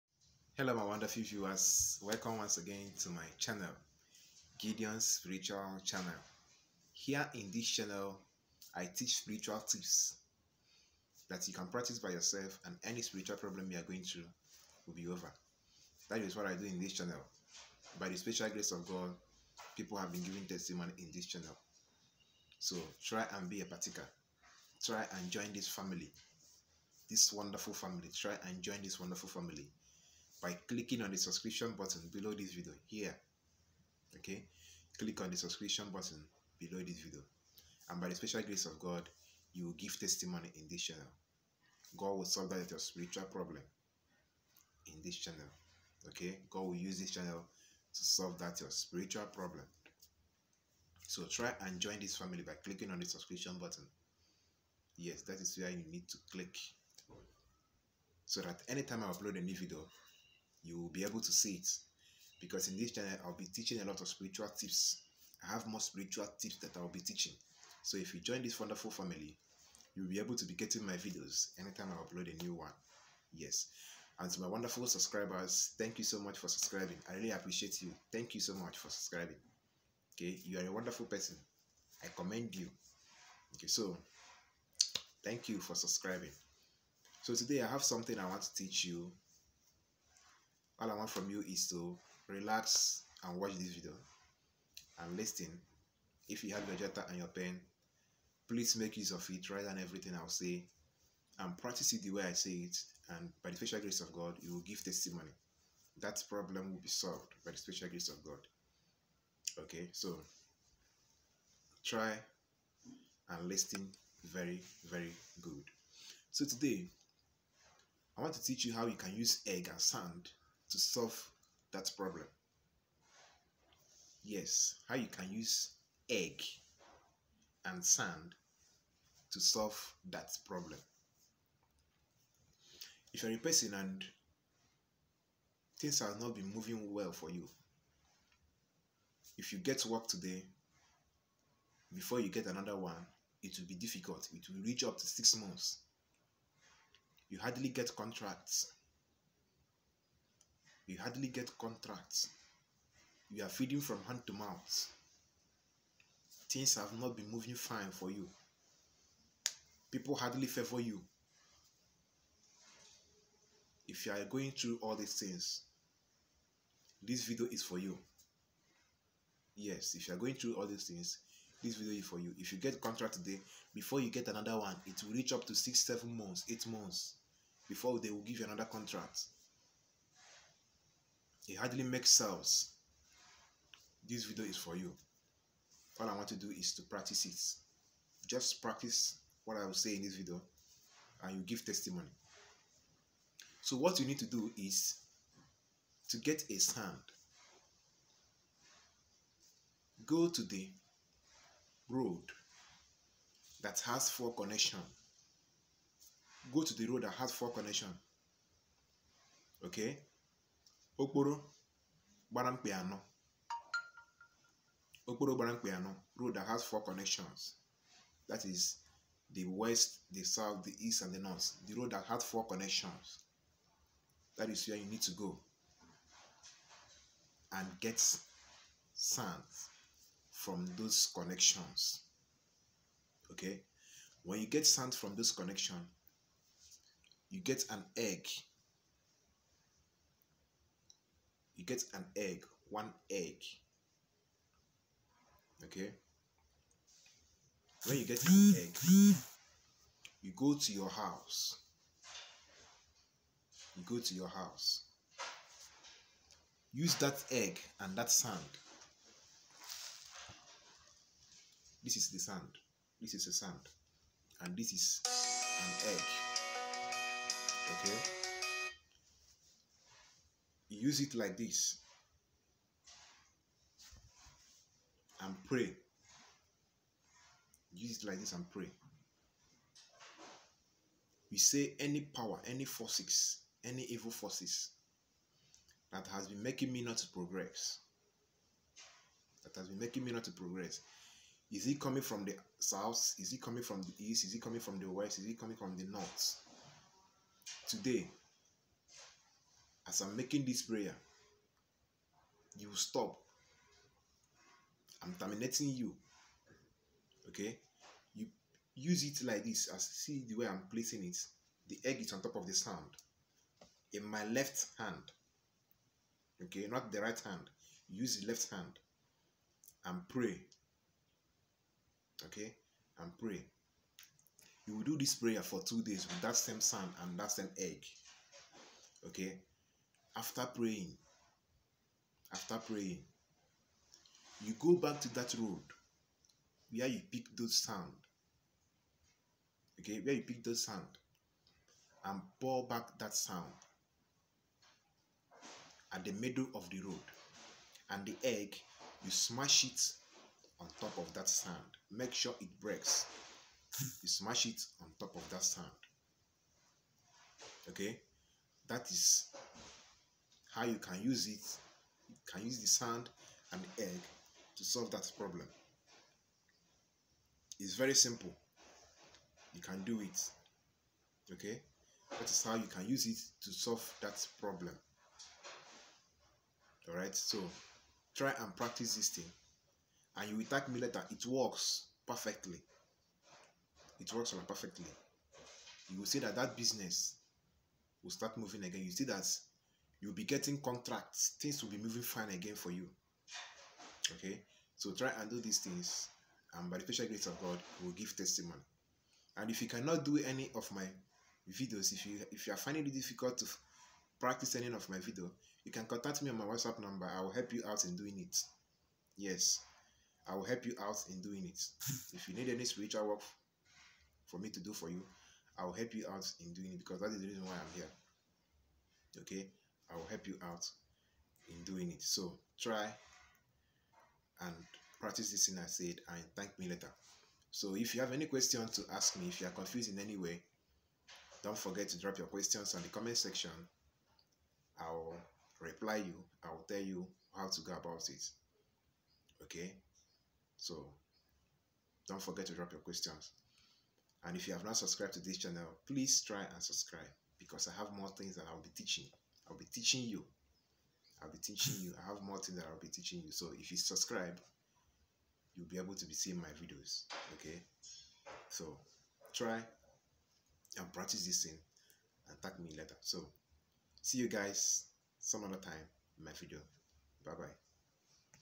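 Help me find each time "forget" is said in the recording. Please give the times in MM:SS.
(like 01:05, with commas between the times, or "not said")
07:11, 07:22.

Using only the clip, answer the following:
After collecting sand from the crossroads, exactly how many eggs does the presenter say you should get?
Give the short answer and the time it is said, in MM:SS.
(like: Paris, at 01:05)
1, at 04:02.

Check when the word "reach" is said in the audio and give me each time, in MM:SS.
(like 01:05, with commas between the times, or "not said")
02:24, 02:55.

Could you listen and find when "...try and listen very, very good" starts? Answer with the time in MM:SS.
01:51.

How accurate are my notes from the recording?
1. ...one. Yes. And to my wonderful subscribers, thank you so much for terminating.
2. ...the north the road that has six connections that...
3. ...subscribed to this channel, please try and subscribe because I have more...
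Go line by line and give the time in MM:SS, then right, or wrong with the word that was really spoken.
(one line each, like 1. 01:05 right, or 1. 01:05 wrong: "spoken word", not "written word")
1. 01:12 wrong: "subscribing", not "terminating"
2. 03:41 wrong: "four", not "six"
3. 07:24 right.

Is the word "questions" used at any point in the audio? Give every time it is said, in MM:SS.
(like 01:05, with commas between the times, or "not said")
07:08, 07:12, 07:22.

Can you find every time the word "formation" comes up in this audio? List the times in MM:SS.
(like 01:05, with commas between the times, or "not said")
not said.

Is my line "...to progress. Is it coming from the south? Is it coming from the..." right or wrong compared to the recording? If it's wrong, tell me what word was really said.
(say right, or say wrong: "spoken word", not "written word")
right.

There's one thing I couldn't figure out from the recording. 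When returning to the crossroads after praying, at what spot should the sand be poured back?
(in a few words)
Middle of the road.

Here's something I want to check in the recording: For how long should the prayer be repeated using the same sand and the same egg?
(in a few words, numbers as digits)
2 days.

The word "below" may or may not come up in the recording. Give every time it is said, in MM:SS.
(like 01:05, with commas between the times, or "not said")
00:32, 00:36.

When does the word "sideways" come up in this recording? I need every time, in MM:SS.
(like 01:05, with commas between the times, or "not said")
not said.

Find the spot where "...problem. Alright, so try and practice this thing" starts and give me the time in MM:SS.
06:14.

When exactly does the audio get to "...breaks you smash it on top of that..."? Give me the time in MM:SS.
05:52.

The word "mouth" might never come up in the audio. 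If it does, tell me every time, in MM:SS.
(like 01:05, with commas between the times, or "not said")
02:34.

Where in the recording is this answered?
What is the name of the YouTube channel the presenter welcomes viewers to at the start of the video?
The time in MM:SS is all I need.
00:04.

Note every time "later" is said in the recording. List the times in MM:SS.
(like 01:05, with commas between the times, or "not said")
06:20, 07:06, 07:42.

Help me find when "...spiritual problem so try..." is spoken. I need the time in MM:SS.
00:48.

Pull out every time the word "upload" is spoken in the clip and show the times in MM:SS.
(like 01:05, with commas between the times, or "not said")
00:59, 01:12.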